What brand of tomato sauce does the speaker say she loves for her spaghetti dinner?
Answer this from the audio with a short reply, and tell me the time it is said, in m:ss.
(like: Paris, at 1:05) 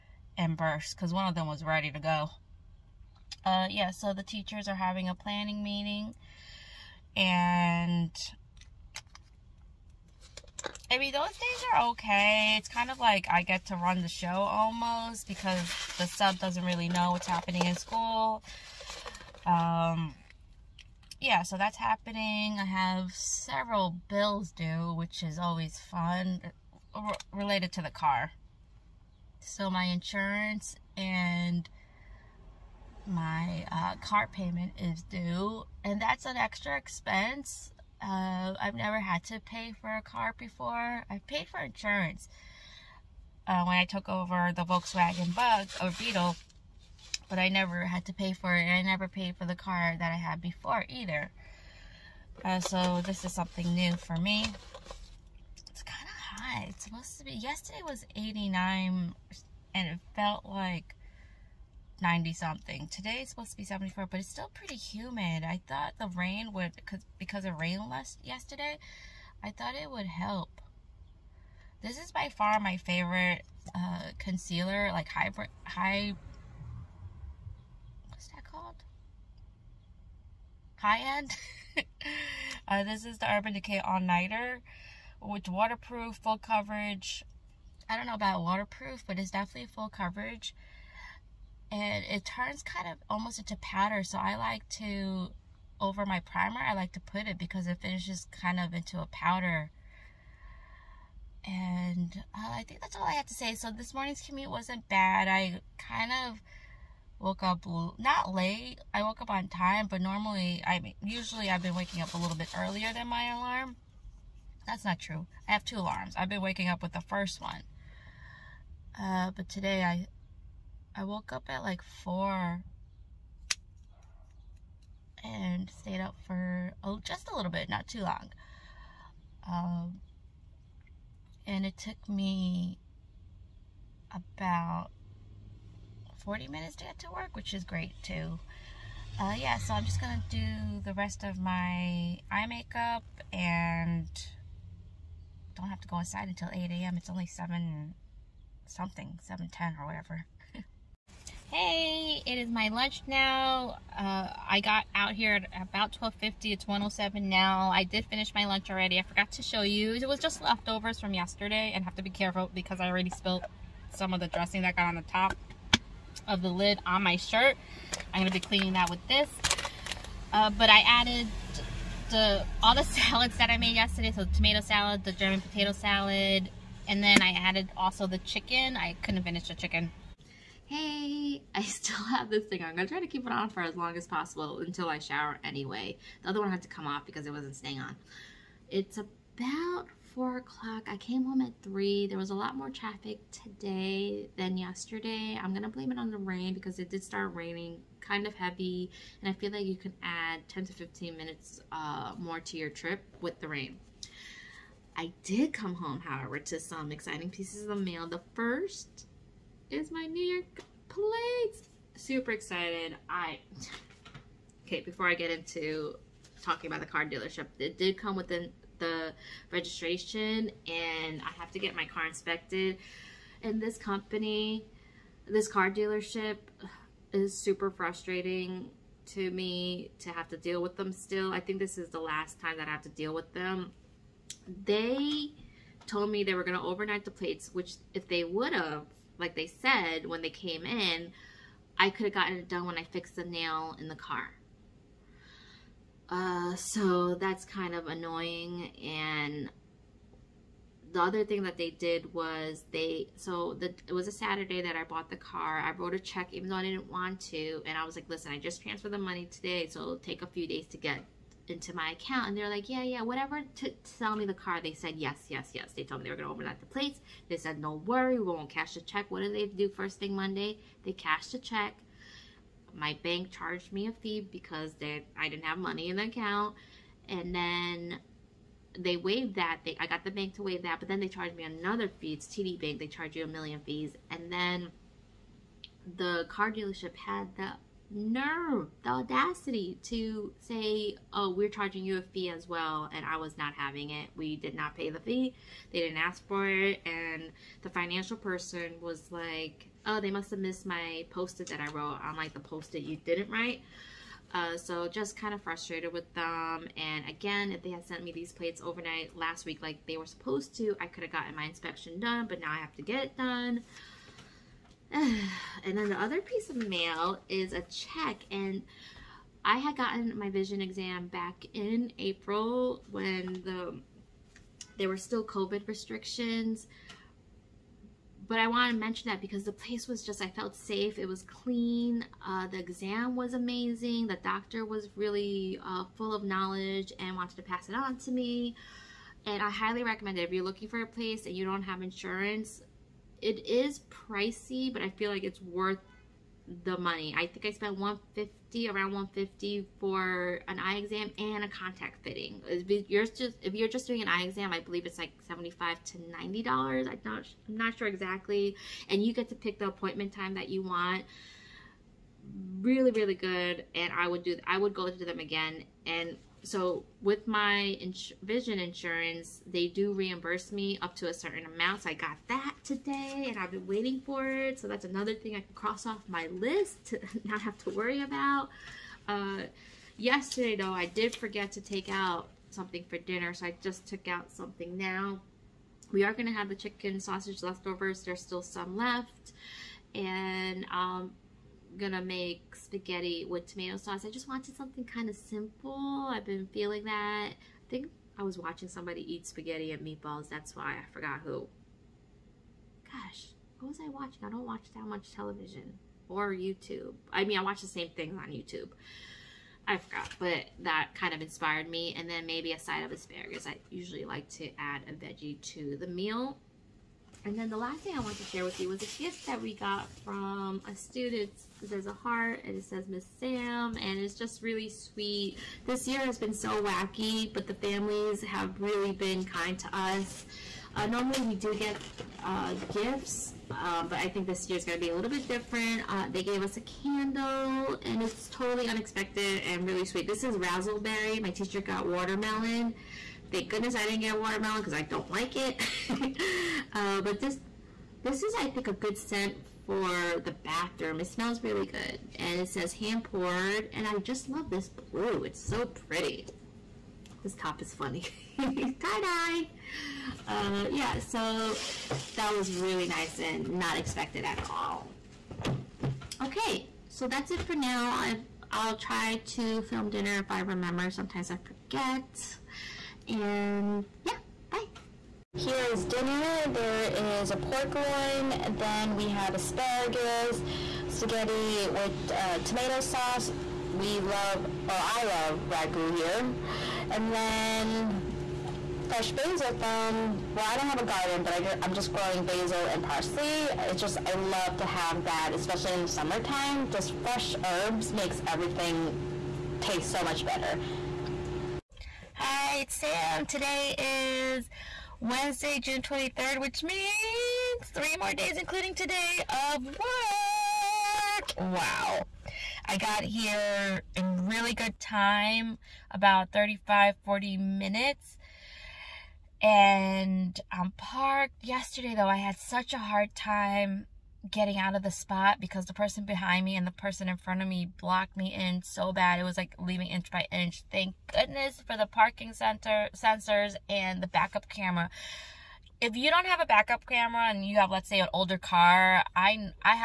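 Ragu, at 8:05.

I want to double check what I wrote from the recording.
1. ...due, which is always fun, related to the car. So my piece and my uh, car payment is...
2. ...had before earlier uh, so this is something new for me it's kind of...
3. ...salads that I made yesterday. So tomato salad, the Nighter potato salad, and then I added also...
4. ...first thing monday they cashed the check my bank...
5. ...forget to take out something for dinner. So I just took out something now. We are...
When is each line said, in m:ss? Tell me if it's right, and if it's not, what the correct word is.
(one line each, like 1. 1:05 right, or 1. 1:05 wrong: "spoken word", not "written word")
1. 0:24 wrong: "insurance", not "piece"
2. 0:50 wrong: "either", not "earlier"
3. 2:52 wrong: "German", not "Nighter"
4. 4:29 right
5. 6:21 right.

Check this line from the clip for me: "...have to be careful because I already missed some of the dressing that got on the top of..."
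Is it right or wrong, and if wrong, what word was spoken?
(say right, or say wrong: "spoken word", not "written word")
wrong: "spilled", not "missed".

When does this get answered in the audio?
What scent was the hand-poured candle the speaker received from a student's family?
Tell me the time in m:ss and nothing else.
7:20.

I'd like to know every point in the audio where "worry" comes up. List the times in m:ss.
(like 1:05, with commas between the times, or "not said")
4:27, 6:17.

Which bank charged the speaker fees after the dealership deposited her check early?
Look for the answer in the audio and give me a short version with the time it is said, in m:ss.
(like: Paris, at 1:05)
TD Bank, at 4:42.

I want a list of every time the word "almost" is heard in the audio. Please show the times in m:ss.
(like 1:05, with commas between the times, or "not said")
0:14, 1:33.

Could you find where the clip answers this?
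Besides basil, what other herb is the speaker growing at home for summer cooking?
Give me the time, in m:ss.
8:12.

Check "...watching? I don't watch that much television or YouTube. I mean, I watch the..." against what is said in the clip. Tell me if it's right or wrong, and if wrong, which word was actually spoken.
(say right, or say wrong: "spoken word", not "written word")
right.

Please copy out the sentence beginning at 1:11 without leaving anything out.
This is by far my favorite uh, concealer, like hybrid, high, what's that called?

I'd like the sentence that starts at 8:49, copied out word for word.
It was like leaving inch by inch.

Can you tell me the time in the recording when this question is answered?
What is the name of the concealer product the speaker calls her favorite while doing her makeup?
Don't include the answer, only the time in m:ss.
1:23.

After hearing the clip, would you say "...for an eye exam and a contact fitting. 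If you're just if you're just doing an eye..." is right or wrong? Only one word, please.
right.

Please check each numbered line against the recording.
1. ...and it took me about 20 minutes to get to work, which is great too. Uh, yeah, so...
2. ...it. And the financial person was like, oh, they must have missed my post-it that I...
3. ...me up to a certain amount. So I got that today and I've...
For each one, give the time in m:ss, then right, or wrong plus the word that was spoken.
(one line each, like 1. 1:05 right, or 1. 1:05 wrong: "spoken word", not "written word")
1. 2:11 wrong: "40", not "20"
2. 4:56 right
3. 6:10 right.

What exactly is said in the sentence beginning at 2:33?
Uh, I got out here at about 12.50.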